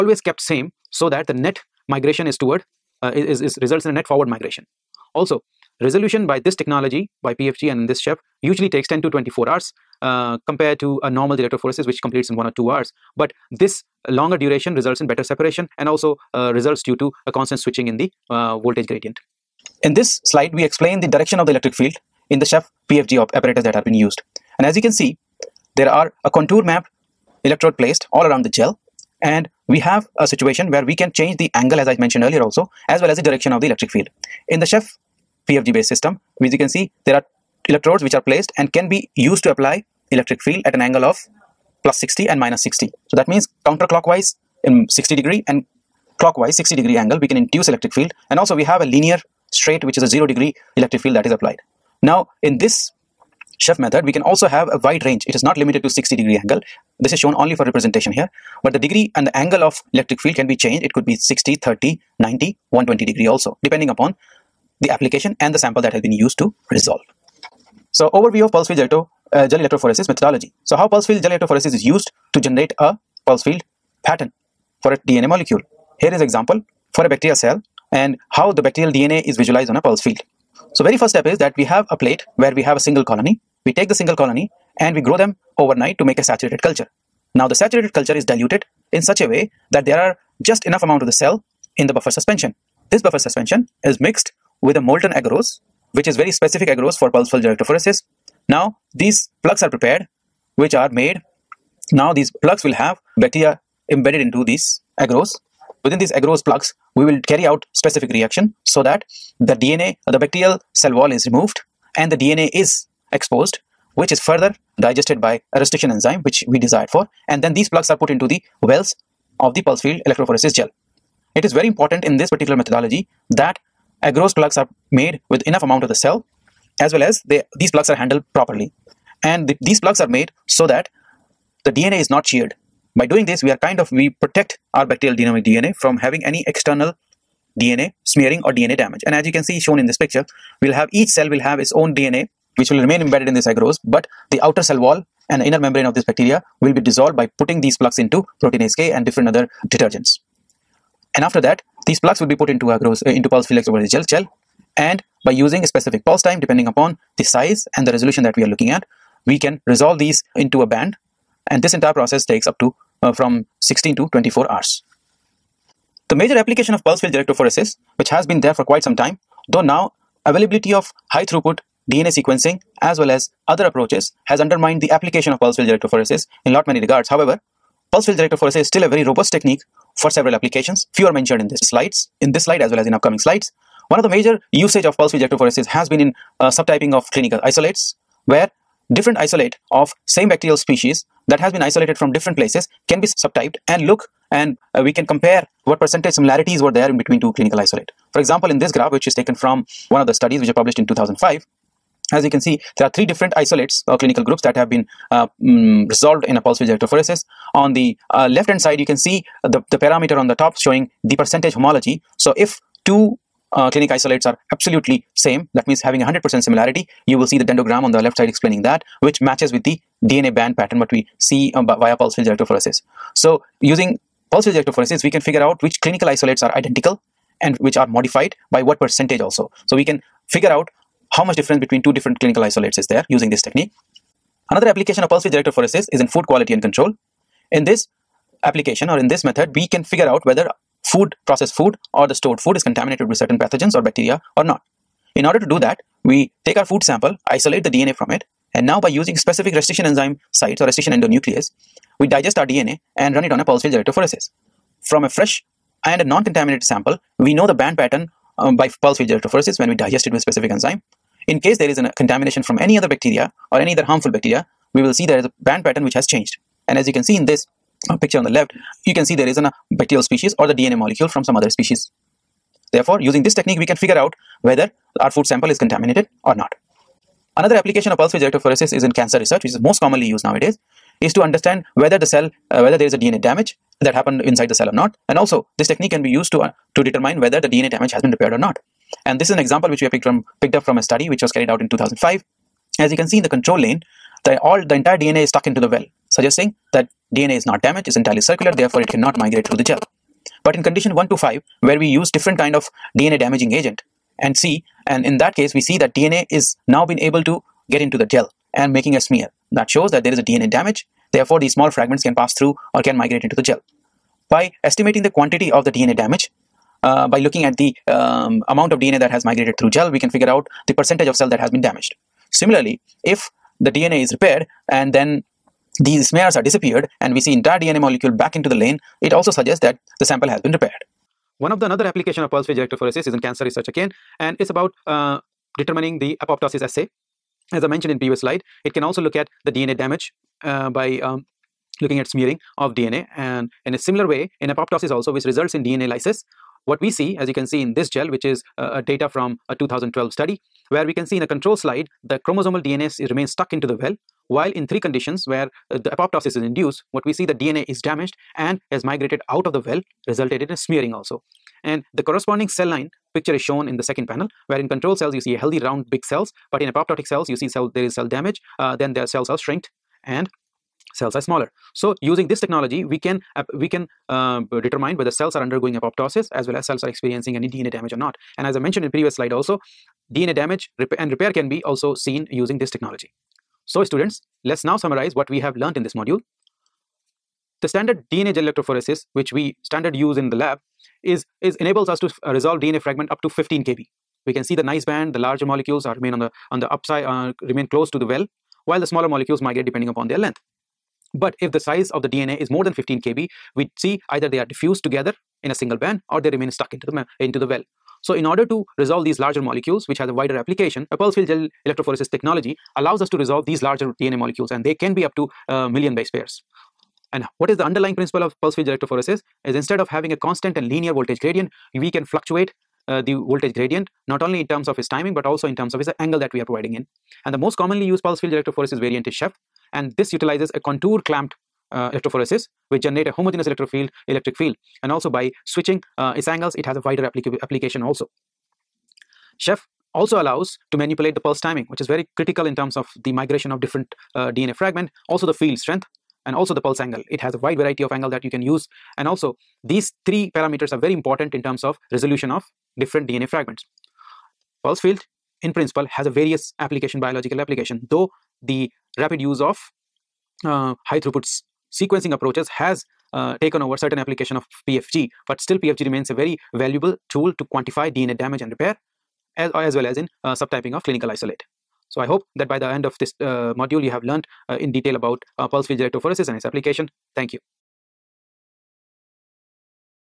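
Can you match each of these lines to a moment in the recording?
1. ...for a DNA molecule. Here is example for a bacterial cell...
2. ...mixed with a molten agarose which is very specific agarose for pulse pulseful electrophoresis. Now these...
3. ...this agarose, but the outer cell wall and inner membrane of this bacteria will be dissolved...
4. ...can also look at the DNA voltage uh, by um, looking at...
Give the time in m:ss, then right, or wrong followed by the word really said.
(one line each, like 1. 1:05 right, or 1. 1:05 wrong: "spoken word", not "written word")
1. 1:14 right
2. 1:33 right
3. 2:23 right
4. 5:38 wrong: "damage", not "voltage".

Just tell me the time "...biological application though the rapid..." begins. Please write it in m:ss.
7:37.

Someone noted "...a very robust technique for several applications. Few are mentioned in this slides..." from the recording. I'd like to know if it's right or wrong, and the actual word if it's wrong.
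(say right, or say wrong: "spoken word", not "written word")
right.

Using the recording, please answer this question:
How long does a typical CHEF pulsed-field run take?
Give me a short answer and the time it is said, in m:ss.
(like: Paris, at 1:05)
10 to 24 hours, at 0:08.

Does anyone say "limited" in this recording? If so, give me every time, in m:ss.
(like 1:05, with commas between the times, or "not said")
0:55.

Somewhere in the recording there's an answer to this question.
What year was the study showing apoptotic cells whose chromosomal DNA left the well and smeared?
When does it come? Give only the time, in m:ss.
5:49.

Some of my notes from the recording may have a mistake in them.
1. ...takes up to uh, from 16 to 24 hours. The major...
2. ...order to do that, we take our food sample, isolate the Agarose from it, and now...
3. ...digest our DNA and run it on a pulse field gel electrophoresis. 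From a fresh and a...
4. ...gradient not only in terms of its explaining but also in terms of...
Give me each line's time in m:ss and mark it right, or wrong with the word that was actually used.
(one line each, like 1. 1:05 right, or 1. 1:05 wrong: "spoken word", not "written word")
1. 2:42 right
2. 4:05 wrong: "DNA", not "Agarose"
3. 4:12 right
4. 7:03 wrong: "timing", not "explaining".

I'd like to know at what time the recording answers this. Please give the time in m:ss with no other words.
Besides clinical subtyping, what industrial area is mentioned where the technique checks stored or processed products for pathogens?
3:56.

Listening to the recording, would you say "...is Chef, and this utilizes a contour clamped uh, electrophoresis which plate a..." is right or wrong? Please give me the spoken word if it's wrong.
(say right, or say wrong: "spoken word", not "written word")
wrong: "generate", not "plate".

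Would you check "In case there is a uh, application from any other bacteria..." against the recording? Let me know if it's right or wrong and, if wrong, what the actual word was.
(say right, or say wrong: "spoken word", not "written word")
wrong: "contamination", not "application".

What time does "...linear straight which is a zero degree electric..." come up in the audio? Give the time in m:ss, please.
0:48.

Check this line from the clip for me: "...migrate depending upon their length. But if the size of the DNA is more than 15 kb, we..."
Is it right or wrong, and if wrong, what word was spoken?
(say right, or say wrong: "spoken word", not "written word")
right.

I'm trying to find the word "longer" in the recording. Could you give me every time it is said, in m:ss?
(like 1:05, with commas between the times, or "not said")
0:14.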